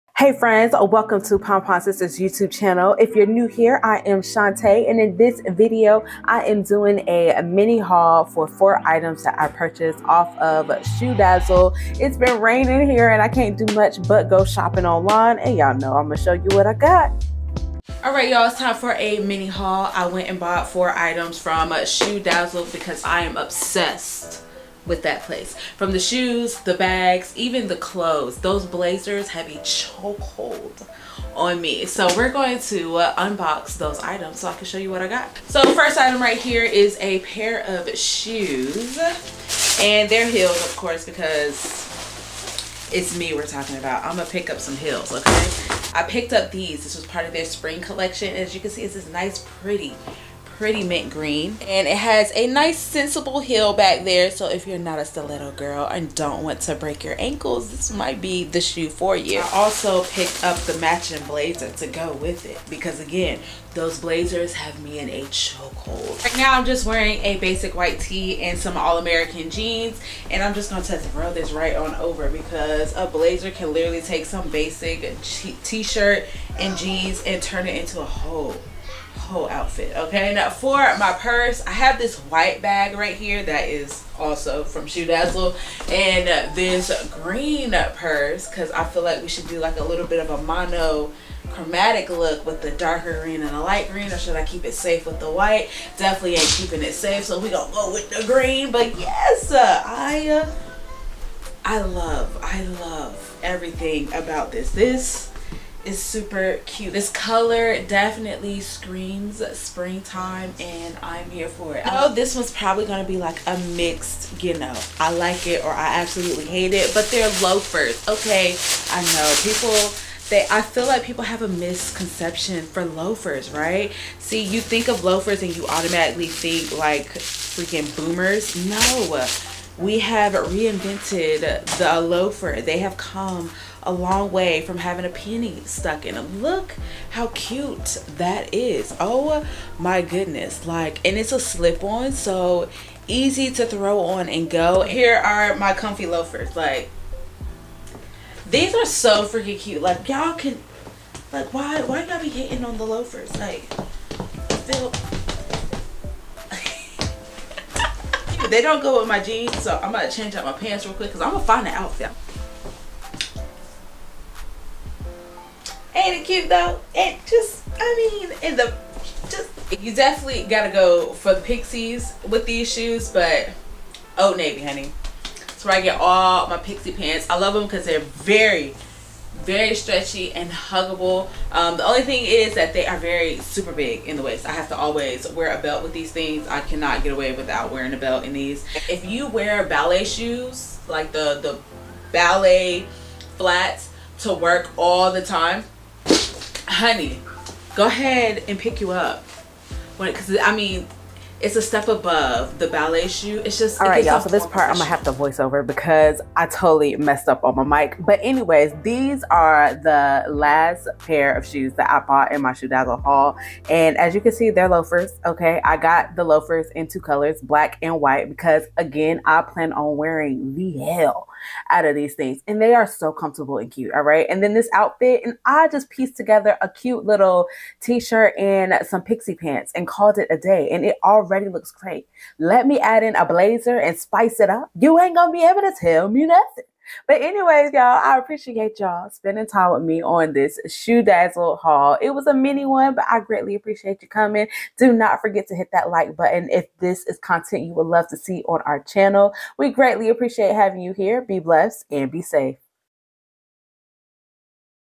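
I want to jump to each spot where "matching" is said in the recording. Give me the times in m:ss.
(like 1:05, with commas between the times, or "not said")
1:00.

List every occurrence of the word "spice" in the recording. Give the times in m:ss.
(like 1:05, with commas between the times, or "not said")
3:53.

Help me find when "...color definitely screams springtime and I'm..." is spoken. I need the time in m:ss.
1:47.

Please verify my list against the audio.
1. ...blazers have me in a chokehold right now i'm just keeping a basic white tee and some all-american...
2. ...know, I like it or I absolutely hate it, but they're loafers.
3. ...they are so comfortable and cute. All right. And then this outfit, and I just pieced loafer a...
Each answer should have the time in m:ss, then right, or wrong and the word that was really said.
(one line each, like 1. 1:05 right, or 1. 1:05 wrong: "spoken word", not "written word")
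1. 1:04 wrong: "wearing", not "keeping"
2. 1:54 right
3. 3:42 wrong: "together", not "loafer".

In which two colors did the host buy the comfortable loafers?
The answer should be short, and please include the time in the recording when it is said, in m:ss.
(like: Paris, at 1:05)
Black and white, at 3:37.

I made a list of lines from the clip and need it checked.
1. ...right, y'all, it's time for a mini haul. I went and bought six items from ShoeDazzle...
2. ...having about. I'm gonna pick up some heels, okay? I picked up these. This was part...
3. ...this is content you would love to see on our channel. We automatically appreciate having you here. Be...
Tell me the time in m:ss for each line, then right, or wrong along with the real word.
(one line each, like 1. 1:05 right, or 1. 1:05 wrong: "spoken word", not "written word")
1. 0:18 wrong: "four", not "six"
2. 0:43 wrong: "talking", not "having"
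3. 4:06 wrong: "greatly", not "automatically".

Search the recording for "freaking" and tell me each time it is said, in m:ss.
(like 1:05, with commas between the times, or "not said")
2:07, 2:29.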